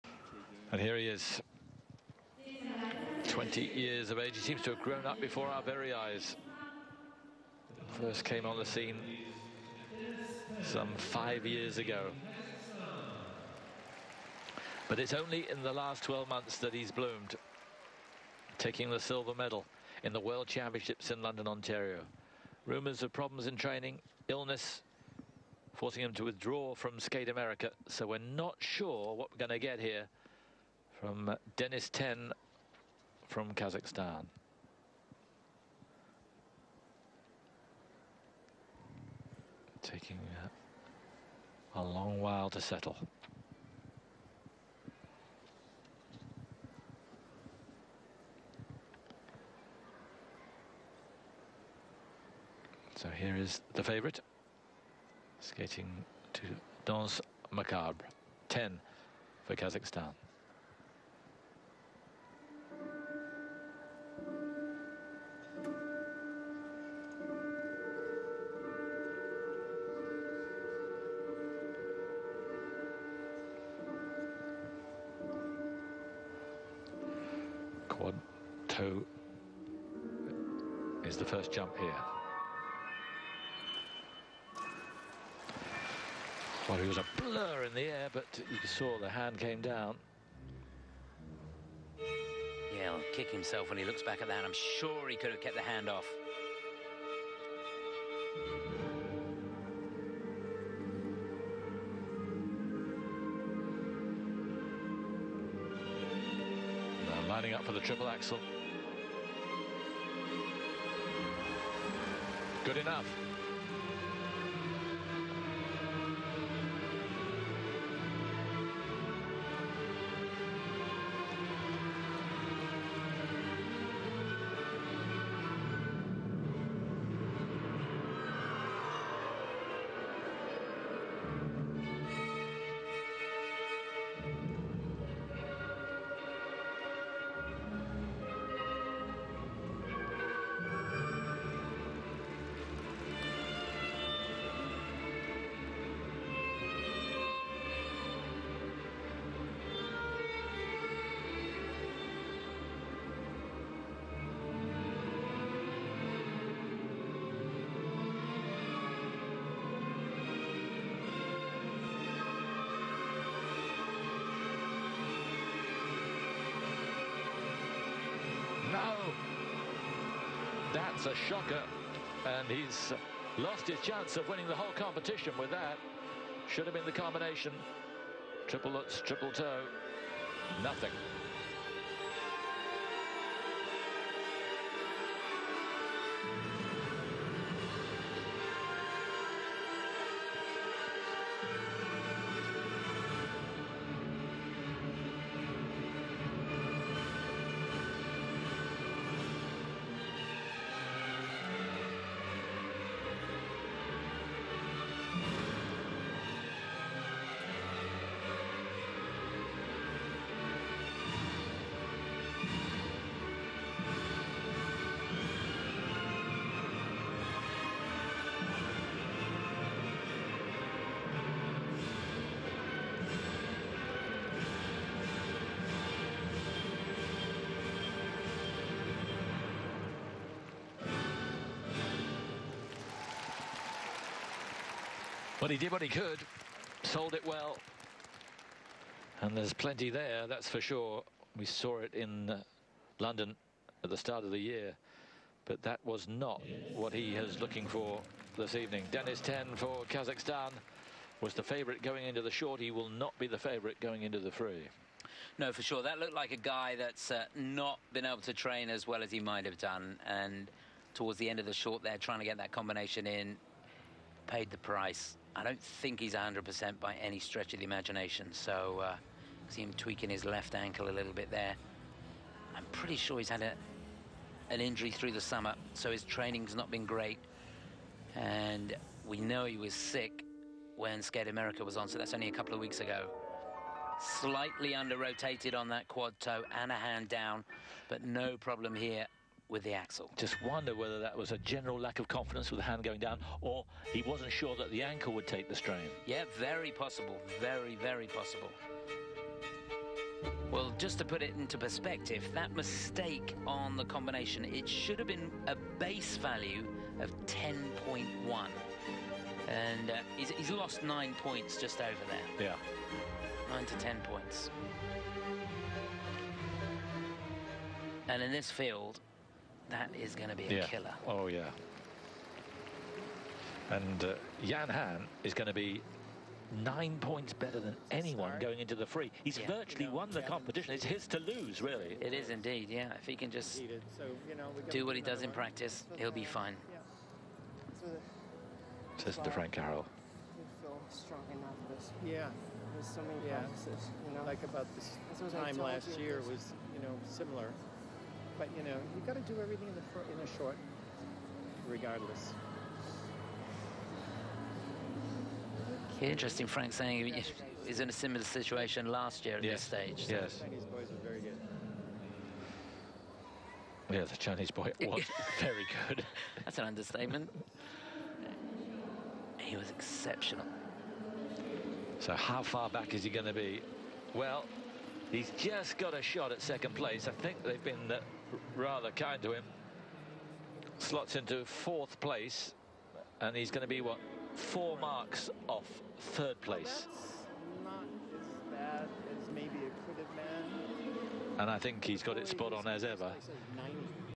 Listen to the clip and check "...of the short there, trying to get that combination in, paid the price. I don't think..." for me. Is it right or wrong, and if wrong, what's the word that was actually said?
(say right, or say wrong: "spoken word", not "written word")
right.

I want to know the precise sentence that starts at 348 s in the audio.
But you know, you got to do everything in the in short, regardless.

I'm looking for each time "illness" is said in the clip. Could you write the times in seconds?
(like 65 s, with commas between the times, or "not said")
24 s.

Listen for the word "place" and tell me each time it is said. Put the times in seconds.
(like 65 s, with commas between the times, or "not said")
376 s, 381 s, 386 s.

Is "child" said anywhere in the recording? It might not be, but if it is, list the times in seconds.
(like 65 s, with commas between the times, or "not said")
not said.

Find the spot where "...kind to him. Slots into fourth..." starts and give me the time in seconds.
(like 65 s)
378 s.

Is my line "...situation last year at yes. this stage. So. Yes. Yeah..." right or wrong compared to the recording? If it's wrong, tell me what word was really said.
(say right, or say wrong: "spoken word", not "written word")
right.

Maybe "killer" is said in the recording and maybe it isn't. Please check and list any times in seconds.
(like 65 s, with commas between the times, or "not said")
320 s.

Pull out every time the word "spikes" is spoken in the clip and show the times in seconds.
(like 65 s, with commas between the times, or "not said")
not said.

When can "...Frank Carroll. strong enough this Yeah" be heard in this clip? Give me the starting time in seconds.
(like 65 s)
339 s.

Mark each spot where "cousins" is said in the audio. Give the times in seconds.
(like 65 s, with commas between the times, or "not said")
not said.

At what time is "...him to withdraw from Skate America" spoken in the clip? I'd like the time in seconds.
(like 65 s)
26 s.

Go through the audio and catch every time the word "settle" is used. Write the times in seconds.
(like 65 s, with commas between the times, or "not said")
42 s.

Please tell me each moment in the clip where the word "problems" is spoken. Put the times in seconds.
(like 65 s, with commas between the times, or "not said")
23 s, 288 s.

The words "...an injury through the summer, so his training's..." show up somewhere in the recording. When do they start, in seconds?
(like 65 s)
274 s.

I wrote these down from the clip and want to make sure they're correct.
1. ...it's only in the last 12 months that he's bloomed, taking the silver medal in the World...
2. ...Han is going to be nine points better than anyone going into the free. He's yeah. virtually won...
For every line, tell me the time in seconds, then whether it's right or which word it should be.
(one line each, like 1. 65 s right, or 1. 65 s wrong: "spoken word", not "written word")
1. 14 s right
2. 324 s right.